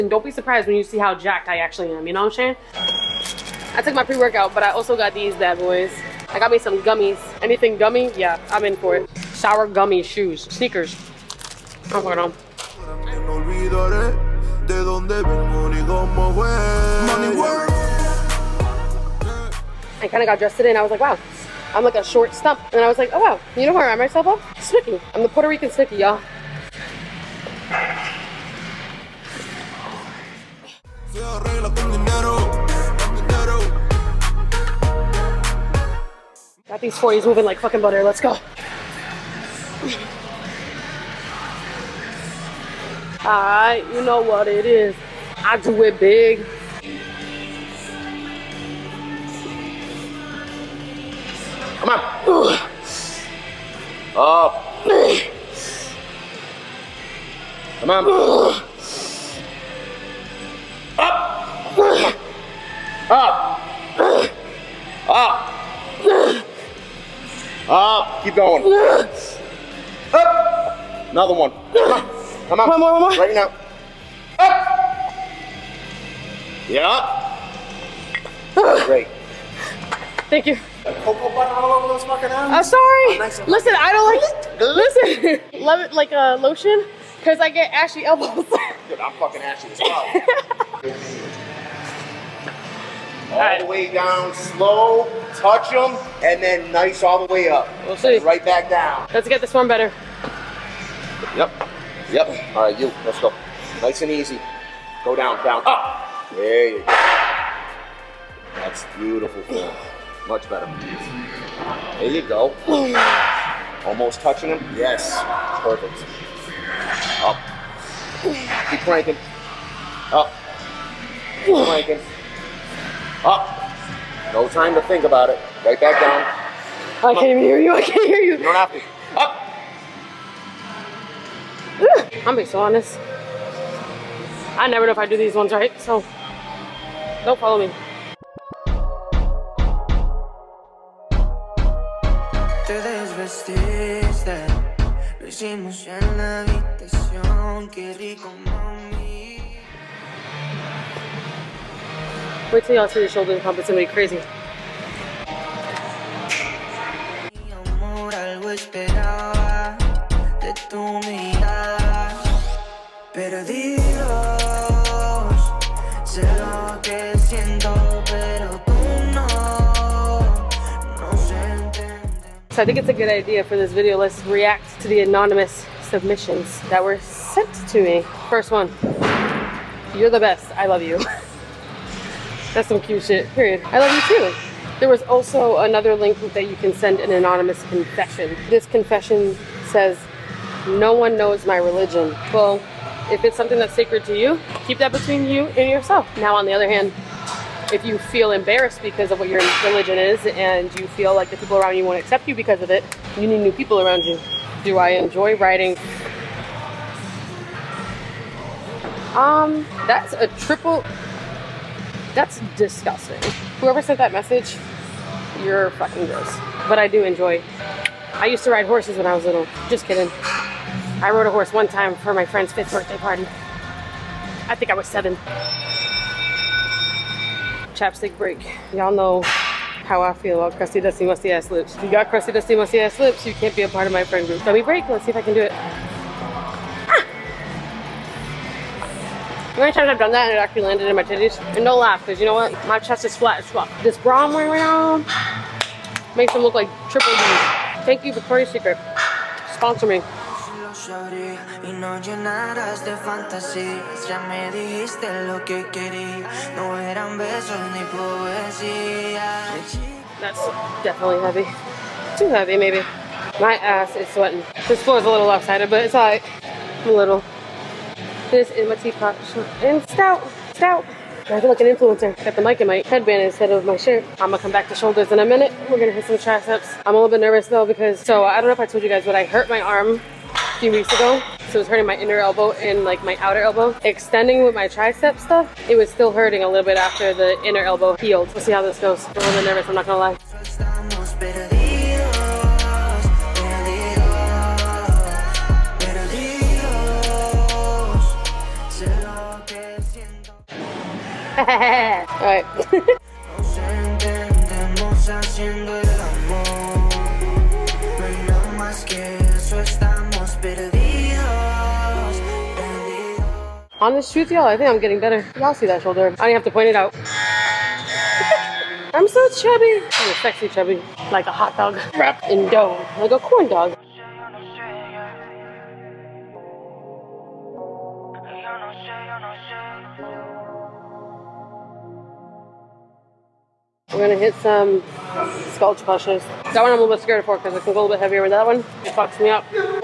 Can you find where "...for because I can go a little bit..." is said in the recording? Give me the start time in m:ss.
5:37.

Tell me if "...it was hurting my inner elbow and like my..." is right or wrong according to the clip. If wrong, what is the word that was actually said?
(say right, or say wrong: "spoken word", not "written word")
right.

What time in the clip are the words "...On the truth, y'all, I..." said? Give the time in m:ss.
5:13.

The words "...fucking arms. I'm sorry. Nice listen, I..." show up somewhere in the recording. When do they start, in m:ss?
1:22.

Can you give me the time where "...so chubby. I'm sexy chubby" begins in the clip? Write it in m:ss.
5:19.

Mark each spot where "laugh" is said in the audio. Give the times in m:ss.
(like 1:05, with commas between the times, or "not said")
4:01.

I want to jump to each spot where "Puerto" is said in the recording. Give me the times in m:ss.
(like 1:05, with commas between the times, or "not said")
0:25.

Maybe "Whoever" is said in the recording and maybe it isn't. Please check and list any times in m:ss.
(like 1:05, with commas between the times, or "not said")
3:33.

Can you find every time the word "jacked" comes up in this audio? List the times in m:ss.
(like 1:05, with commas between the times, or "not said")
0:01.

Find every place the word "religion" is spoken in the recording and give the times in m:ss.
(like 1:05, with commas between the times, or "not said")
3:11, 3:19.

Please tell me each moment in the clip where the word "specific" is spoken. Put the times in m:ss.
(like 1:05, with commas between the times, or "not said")
not said.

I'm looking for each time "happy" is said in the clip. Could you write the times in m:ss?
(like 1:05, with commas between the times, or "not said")
not said.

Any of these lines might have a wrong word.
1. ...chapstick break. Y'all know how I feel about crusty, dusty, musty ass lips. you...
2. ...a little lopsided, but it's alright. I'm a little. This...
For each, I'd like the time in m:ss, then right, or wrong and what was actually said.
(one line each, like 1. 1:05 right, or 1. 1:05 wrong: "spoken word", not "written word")
1. 3:47 right
2. 4:25 right.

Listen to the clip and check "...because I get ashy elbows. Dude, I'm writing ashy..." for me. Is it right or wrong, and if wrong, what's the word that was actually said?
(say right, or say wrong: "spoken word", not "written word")
wrong: "fucking", not "writing".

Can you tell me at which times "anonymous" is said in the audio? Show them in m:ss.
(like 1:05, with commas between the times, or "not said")
2:54, 3:07.